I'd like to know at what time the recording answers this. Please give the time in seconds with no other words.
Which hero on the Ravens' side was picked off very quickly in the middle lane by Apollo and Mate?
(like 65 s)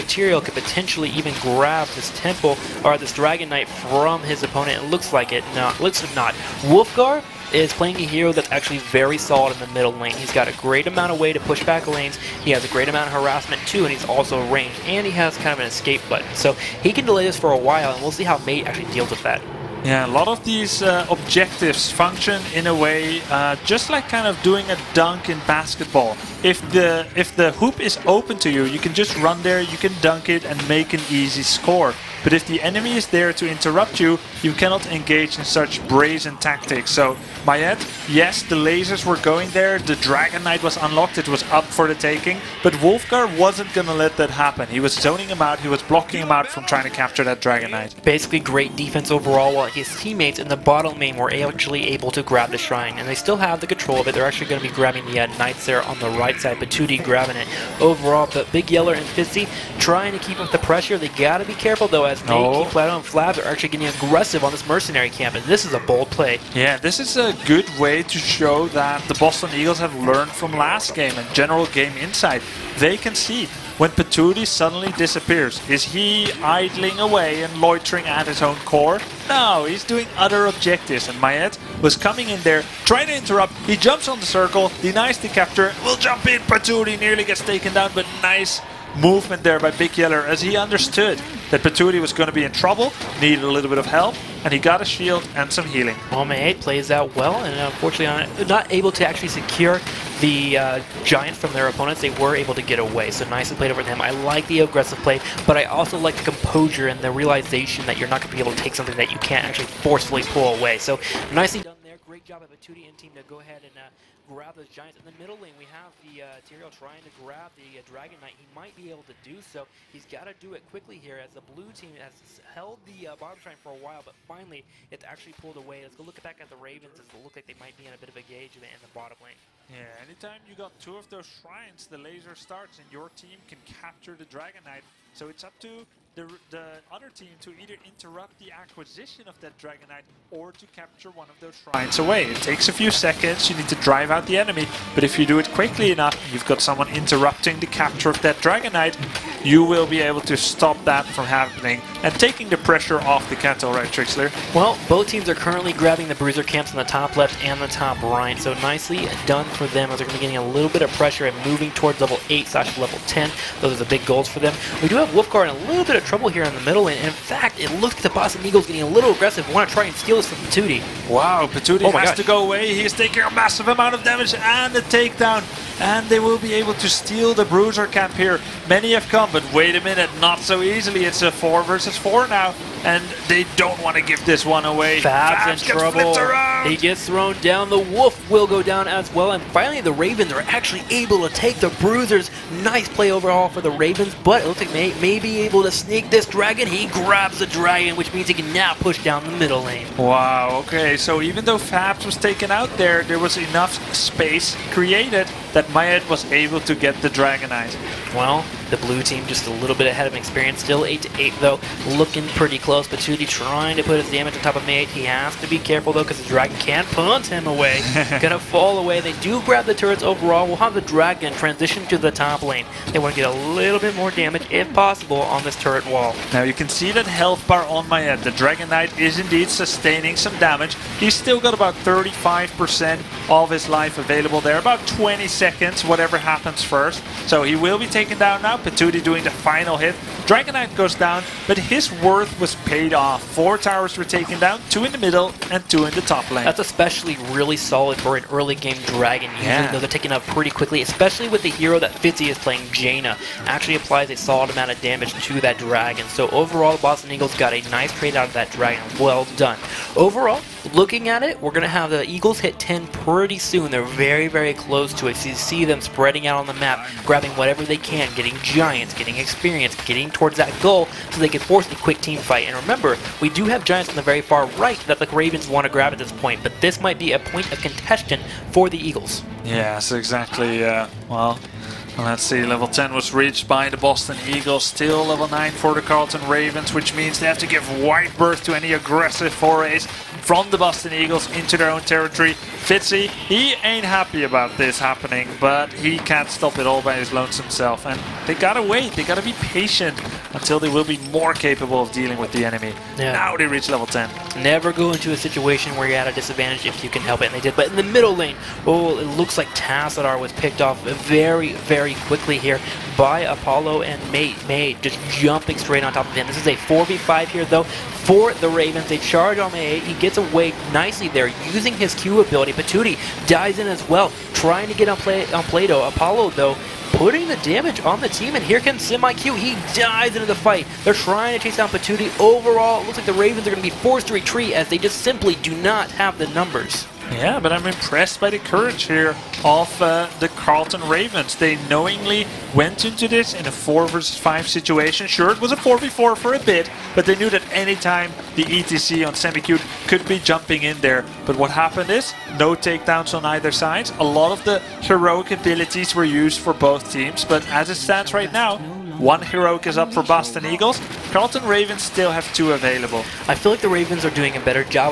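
309 s.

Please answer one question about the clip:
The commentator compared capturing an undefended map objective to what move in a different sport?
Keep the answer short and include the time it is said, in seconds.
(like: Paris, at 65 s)
A dunk in basketball, at 24 s.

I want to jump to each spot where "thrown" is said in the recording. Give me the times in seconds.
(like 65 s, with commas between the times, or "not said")
187 s.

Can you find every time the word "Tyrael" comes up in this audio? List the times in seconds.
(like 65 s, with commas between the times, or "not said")
0 s, 116 s.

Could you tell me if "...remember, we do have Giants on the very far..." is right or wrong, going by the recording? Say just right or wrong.
right.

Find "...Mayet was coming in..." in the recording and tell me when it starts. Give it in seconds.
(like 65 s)
81 s.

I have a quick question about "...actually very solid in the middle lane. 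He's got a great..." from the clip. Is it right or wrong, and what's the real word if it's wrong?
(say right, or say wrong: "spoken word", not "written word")
right.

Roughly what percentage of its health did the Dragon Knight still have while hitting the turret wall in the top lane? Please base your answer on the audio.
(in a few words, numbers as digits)
35%.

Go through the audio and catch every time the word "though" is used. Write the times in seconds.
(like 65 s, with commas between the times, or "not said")
61 s, 201 s, 211 s, 215 s, 249 s, 317 s, 326 s.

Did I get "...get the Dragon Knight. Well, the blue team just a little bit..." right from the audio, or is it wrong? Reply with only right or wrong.
right.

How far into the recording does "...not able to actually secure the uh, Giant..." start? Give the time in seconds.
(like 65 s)
98 s.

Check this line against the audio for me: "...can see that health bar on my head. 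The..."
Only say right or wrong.
right.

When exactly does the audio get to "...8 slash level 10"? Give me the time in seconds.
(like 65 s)
162 s.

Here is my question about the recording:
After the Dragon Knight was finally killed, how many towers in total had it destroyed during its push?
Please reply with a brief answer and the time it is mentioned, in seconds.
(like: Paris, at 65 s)
4, at 243 s.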